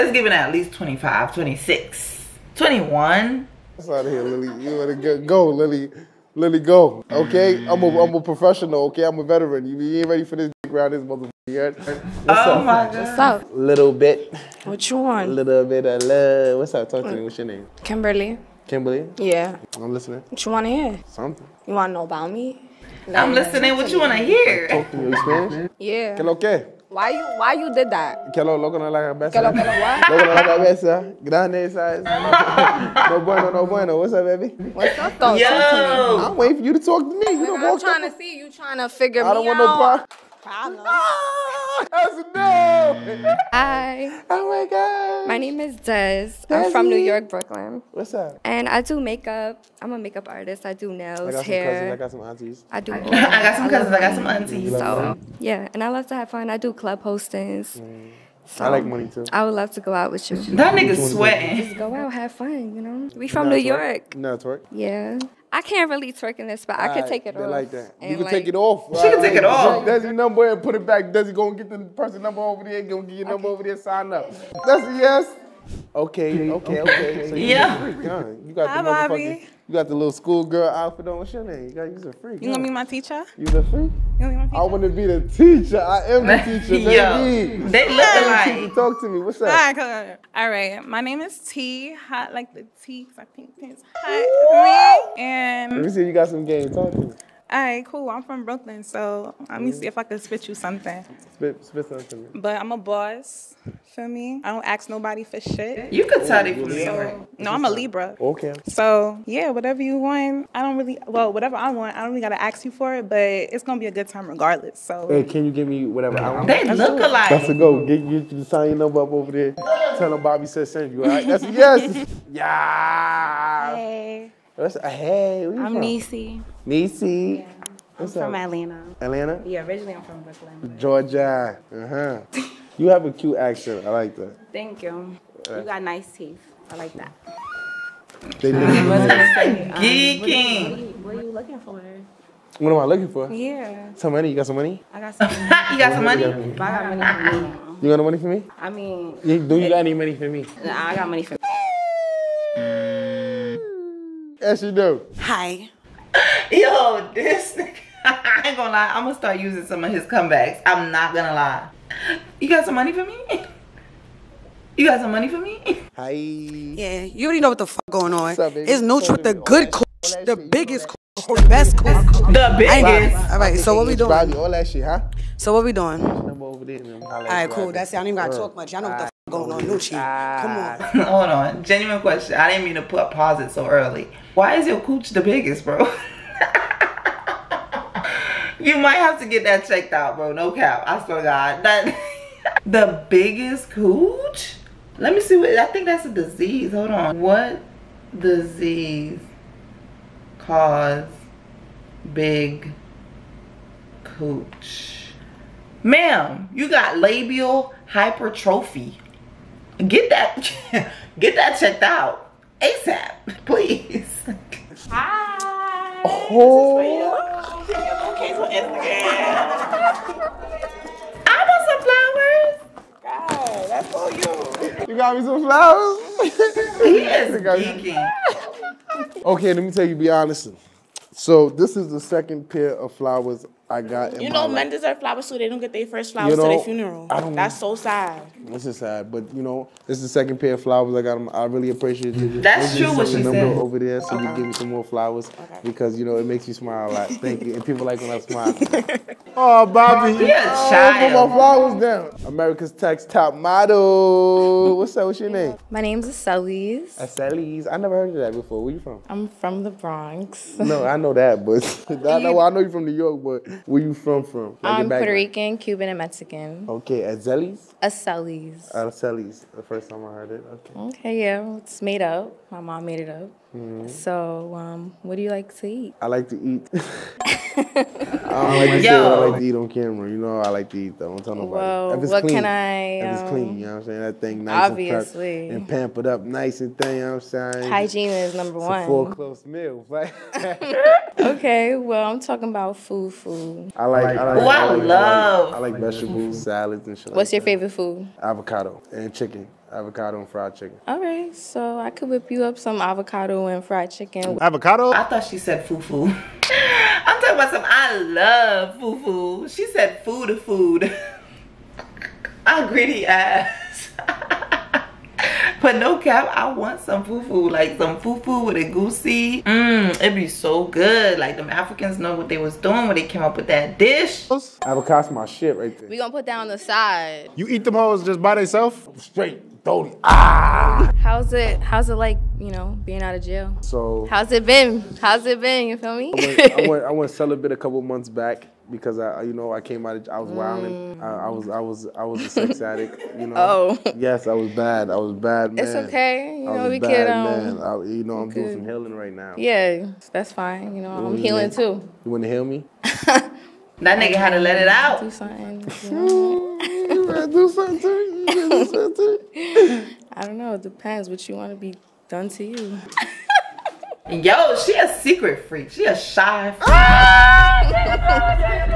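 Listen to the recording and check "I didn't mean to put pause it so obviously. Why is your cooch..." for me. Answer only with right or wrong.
wrong.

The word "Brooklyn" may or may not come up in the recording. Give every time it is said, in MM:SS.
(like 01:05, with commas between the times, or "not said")
00:47, 01:38, 02:10.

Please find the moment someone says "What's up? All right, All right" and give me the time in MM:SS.
01:29.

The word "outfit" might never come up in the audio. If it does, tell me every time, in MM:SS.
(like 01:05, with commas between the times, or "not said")
01:20.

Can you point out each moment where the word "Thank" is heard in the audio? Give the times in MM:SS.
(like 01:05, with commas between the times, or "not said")
02:14, 04:07.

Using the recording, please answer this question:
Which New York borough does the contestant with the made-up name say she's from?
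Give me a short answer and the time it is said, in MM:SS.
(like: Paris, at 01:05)
The Bronx, at 04:19.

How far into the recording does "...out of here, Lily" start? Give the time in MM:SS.
00:03.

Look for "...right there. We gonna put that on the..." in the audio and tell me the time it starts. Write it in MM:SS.
05:25.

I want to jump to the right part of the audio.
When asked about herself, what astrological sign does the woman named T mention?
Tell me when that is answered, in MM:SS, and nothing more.
01:47.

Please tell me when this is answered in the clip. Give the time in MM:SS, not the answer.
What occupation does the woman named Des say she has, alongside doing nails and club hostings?
00:49.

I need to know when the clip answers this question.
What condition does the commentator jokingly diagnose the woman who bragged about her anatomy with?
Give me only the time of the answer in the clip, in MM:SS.
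03:26.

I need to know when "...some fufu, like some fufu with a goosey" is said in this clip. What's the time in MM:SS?
05:16.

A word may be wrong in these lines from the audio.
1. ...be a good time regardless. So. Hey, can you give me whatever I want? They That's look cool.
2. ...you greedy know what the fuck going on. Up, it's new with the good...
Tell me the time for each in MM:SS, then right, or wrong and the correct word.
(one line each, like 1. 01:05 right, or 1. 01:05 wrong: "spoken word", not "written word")
1. 01:53 right
2. 02:47 wrong: "already", not "greedy".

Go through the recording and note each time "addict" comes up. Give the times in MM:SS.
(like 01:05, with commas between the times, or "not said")
05:42.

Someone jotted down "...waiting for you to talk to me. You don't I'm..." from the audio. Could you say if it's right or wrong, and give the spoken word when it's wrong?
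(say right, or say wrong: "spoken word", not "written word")
right.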